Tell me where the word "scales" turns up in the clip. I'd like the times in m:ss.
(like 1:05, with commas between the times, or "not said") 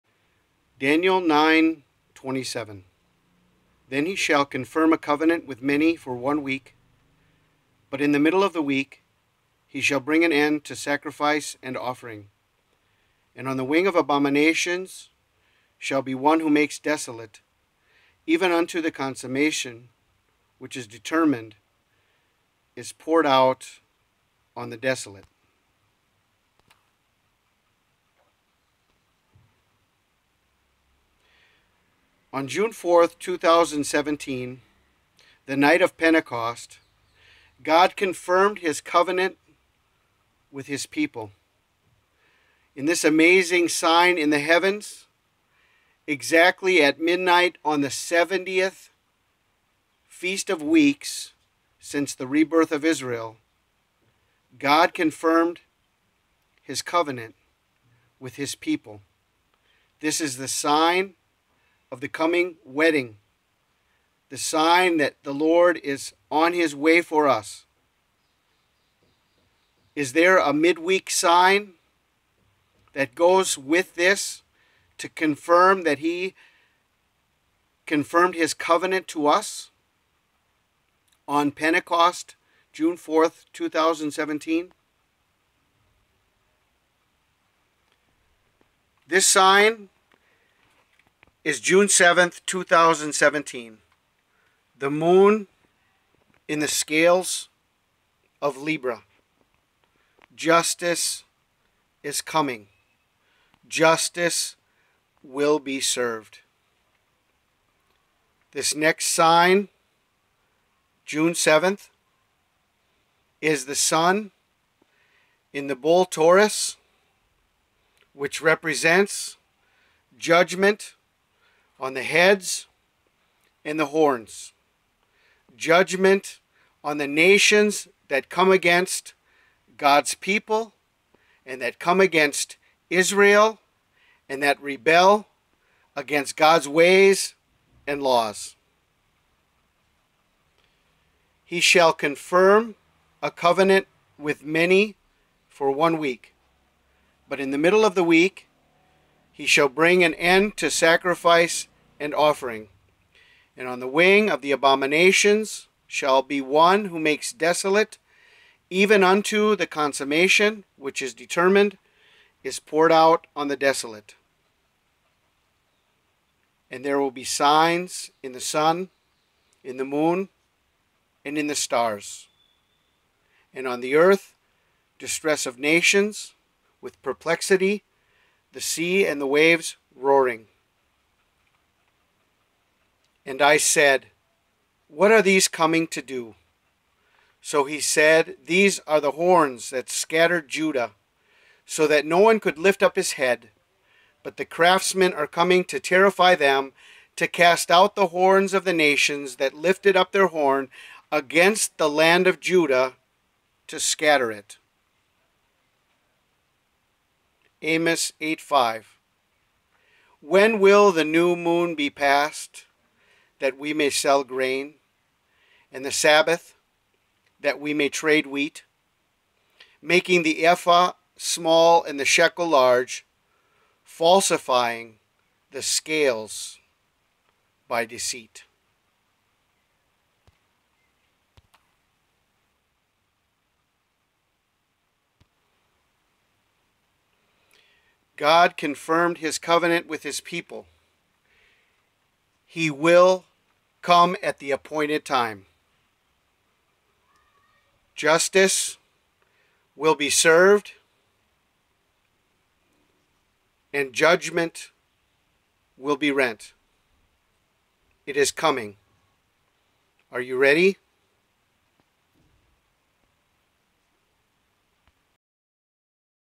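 1:36, 3:45.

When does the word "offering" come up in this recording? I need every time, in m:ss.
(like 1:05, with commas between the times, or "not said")
0:11, 2:32.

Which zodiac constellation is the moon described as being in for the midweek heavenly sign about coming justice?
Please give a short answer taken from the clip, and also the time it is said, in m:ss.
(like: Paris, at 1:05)
Libra, at 1:38.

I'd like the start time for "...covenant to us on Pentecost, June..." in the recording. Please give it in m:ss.
1:18.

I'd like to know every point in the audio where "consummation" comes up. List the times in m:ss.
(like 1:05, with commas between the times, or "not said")
0:18, 2:39.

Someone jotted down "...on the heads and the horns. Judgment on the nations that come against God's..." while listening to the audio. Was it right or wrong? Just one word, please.
right.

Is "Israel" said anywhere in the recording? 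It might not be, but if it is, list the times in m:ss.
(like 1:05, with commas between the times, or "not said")
0:52, 2:12.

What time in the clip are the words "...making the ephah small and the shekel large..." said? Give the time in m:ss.
3:39.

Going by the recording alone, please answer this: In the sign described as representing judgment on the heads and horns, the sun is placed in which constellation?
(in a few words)
Taurus.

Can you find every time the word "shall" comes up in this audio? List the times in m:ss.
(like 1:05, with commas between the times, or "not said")
0:04, 0:09, 0:15, 2:21, 2:29, 2:35.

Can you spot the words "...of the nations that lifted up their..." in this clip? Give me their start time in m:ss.
3:18.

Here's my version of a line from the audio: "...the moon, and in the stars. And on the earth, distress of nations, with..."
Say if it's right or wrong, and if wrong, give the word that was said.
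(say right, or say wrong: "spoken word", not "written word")
right.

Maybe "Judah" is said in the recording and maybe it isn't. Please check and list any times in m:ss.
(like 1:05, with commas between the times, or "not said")
3:10, 3:22.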